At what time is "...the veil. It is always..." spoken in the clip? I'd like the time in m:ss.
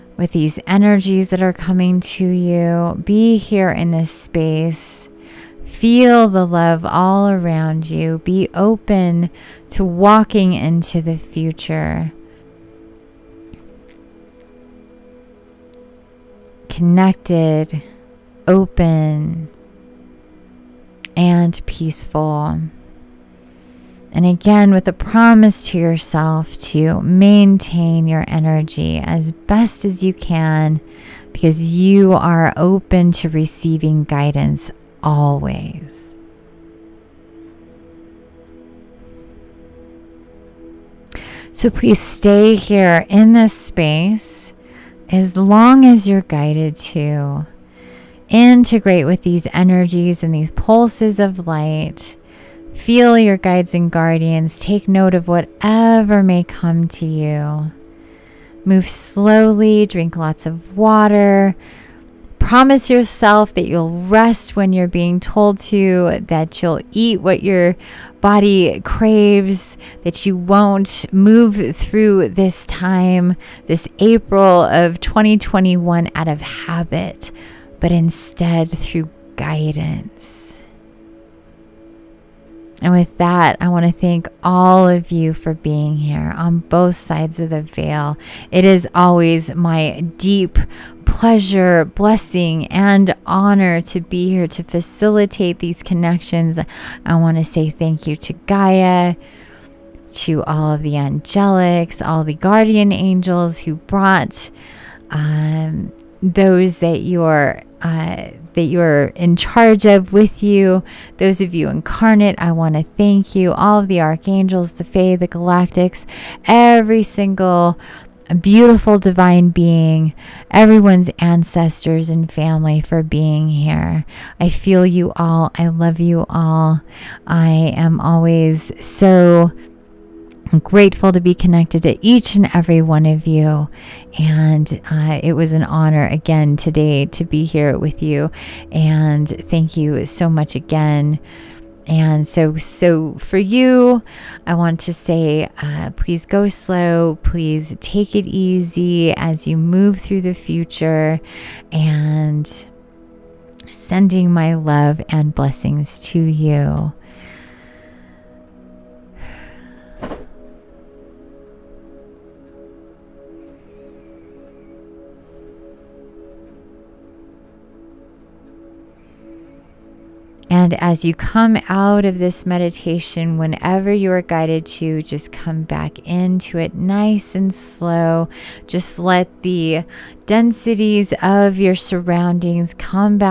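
1:27.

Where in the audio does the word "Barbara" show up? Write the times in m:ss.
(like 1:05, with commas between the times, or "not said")
not said.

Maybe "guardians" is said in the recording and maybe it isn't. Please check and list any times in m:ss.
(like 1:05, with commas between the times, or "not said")
0:53, 1:42.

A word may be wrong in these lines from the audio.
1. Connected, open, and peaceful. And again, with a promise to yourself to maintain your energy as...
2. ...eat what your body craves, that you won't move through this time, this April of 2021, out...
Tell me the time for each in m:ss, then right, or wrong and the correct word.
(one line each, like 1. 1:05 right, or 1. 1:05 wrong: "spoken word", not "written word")
1. 0:16 right
2. 1:06 right.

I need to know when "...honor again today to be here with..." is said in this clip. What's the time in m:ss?
2:15.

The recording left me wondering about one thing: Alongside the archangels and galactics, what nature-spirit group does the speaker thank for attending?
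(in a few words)
The Fae.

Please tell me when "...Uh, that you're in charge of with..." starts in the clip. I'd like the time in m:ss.
1:47.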